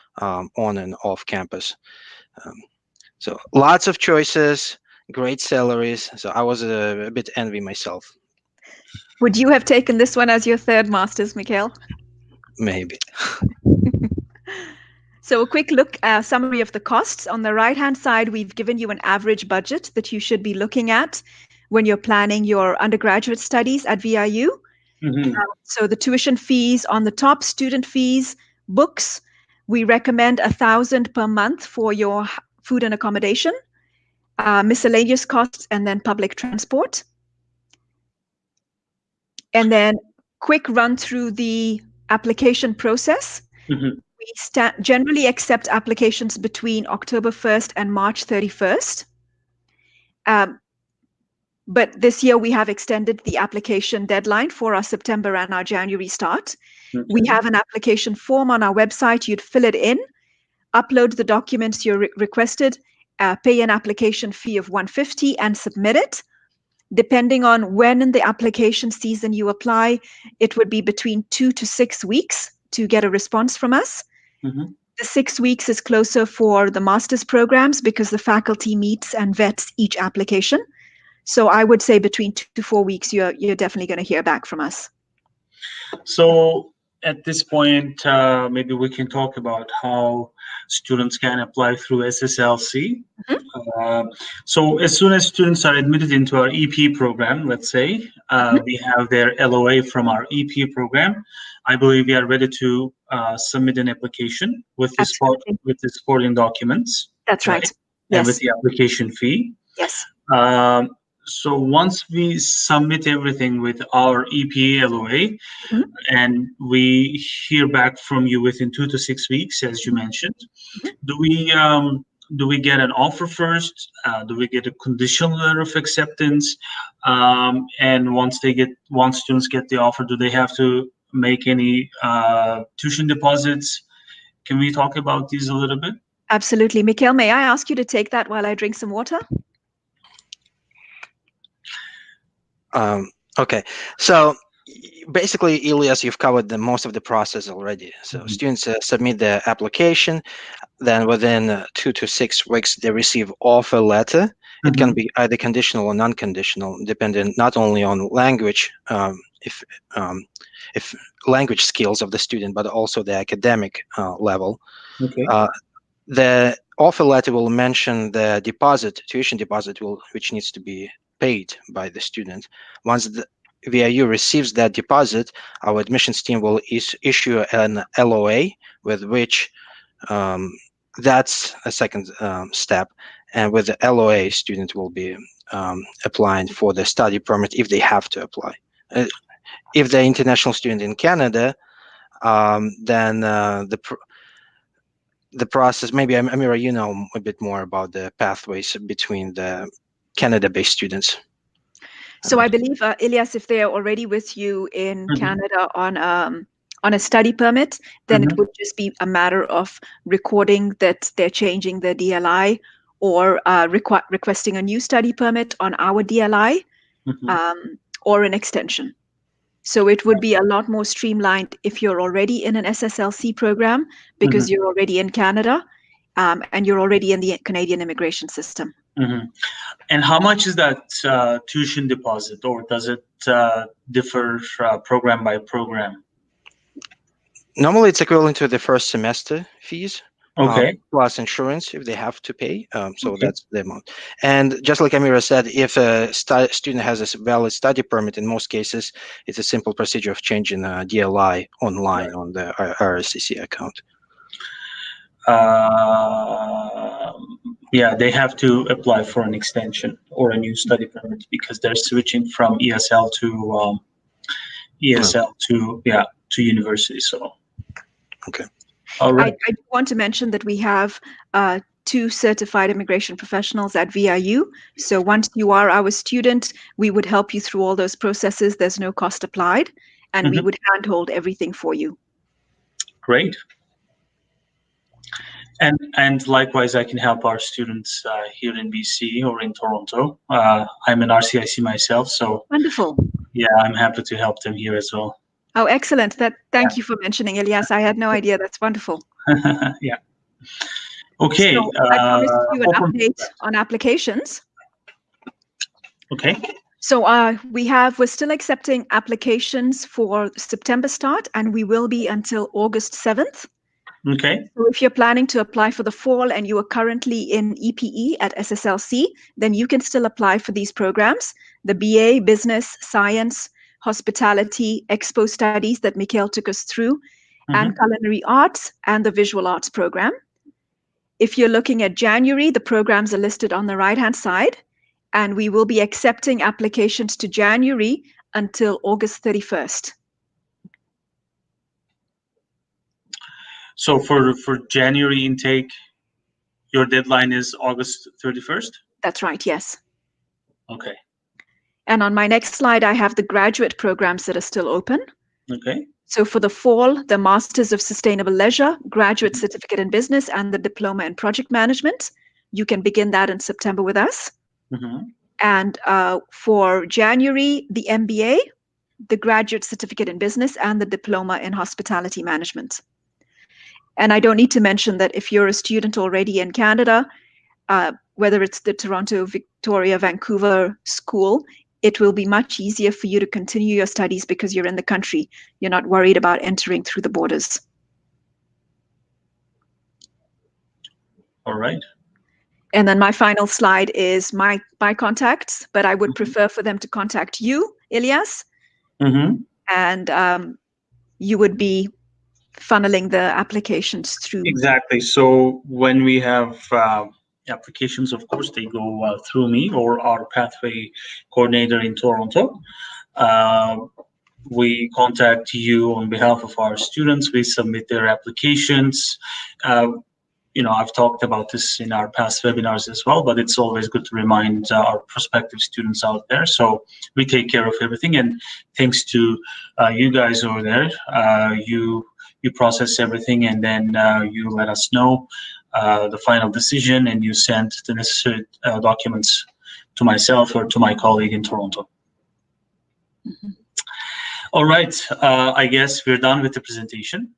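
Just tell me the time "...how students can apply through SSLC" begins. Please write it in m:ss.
1:29.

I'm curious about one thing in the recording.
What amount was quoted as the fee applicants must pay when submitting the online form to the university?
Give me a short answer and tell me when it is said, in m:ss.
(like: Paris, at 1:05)
150, at 1:04.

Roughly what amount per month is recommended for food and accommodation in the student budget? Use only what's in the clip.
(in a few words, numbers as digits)
a thousand.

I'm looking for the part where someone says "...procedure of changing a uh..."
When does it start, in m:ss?
4:09.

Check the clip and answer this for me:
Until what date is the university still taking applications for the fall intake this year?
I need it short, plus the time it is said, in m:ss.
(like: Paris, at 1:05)
August 7th, at 5:12.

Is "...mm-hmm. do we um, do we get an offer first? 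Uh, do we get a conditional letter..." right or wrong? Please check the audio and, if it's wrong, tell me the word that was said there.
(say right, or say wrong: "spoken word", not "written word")
right.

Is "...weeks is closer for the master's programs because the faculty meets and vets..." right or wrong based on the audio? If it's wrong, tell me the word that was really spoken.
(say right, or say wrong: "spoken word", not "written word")
right.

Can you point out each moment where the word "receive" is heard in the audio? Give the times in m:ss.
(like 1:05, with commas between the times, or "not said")
2:32, 2:54.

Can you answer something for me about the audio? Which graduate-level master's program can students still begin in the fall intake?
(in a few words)
Masters of Sustainable Leisure.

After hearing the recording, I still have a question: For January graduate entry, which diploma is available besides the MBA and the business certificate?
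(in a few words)
Diploma in Hospitality Management.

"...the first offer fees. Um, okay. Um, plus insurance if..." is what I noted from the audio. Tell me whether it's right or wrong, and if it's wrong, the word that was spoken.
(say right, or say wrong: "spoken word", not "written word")
wrong: "semester", not "offer".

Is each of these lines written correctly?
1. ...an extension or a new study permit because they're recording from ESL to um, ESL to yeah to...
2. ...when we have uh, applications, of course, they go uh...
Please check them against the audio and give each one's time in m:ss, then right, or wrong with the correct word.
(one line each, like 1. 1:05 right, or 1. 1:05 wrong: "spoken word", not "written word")
1. 4:19 wrong: "switching", not "recording"
2. 6:45 right.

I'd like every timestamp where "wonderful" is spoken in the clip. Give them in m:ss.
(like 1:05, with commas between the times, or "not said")
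4:52, 4:58.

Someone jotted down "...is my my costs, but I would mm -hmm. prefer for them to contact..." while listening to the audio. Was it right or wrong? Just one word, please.
wrong.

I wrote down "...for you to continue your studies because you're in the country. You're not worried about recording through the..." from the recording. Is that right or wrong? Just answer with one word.
wrong.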